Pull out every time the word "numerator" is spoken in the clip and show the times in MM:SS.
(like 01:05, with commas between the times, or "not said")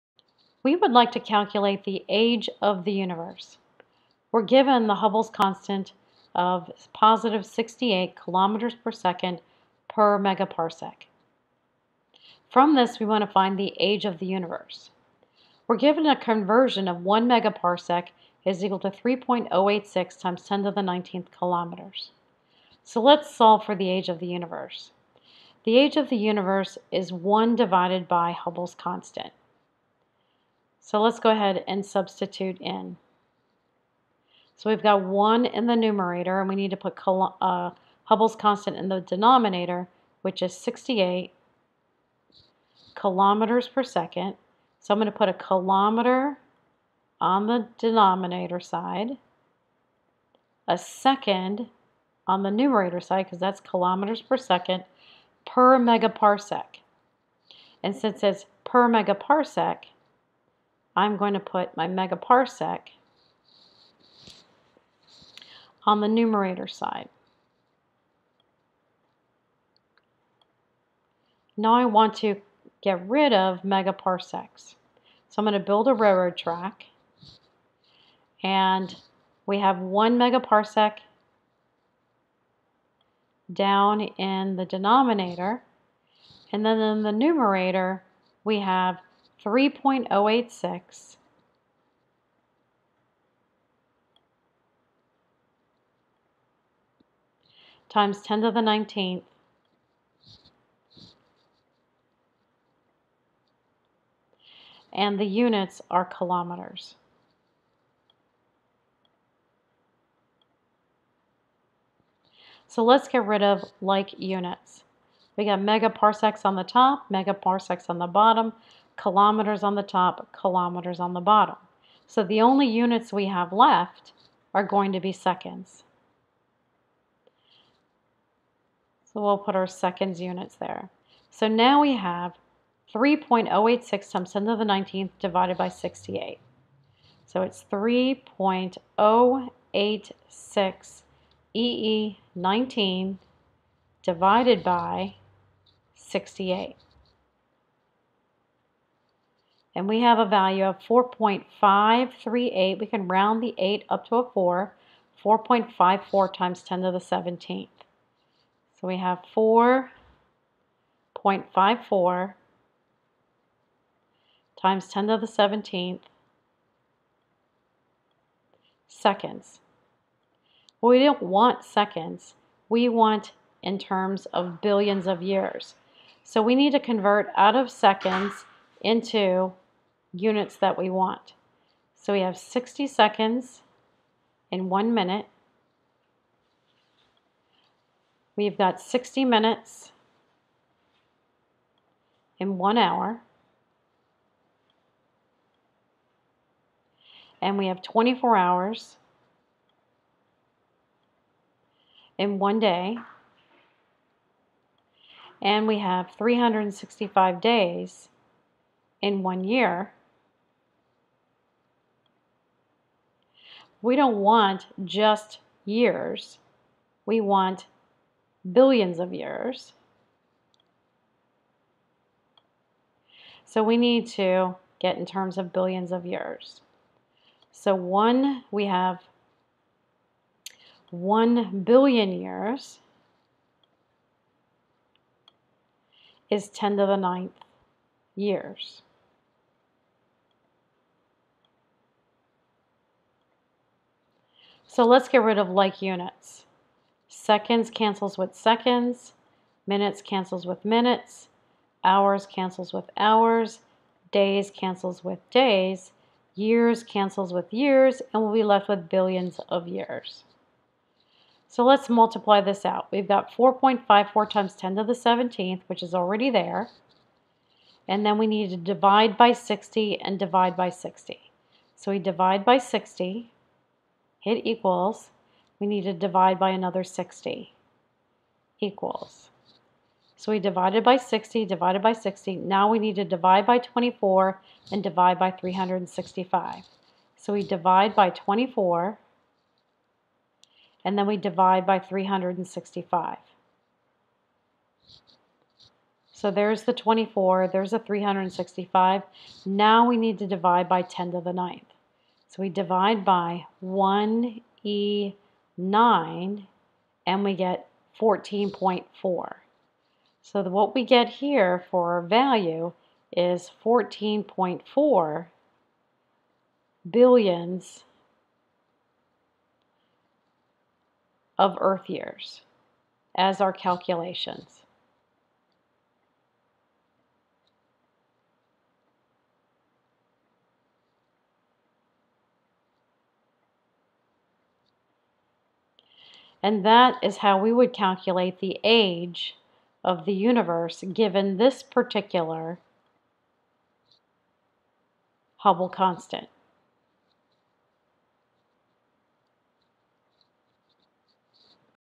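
00:35, 00:52, 01:06, 01:27.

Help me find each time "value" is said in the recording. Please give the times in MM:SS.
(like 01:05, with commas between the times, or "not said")
02:30, 05:12.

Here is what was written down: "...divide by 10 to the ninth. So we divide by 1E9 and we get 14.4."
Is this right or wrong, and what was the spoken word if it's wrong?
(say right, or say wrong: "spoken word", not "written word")
right.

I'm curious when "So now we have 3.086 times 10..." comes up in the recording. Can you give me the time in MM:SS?
02:11.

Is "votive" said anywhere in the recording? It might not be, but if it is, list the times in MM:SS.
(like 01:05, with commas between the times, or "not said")
not said.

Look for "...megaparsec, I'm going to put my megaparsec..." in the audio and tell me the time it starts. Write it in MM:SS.
00:58.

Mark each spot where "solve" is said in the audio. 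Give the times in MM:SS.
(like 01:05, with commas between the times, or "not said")
00:23.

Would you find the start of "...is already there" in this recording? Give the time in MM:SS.
04:25.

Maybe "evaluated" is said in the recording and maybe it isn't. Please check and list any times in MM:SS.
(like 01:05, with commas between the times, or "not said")
not said.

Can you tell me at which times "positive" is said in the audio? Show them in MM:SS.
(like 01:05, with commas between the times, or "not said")
00:06.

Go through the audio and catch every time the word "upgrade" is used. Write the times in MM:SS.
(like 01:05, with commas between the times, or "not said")
not said.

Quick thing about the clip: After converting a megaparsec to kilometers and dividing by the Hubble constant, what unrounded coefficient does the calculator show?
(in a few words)
4.538.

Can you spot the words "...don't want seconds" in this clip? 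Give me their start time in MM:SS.
02:50.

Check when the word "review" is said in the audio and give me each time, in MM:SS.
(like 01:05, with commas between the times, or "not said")
not said.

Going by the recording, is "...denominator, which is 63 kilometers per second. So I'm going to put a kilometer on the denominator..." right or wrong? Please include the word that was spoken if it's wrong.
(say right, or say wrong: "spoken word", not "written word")
wrong: "68", not "63".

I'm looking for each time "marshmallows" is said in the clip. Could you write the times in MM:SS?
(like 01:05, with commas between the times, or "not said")
not said.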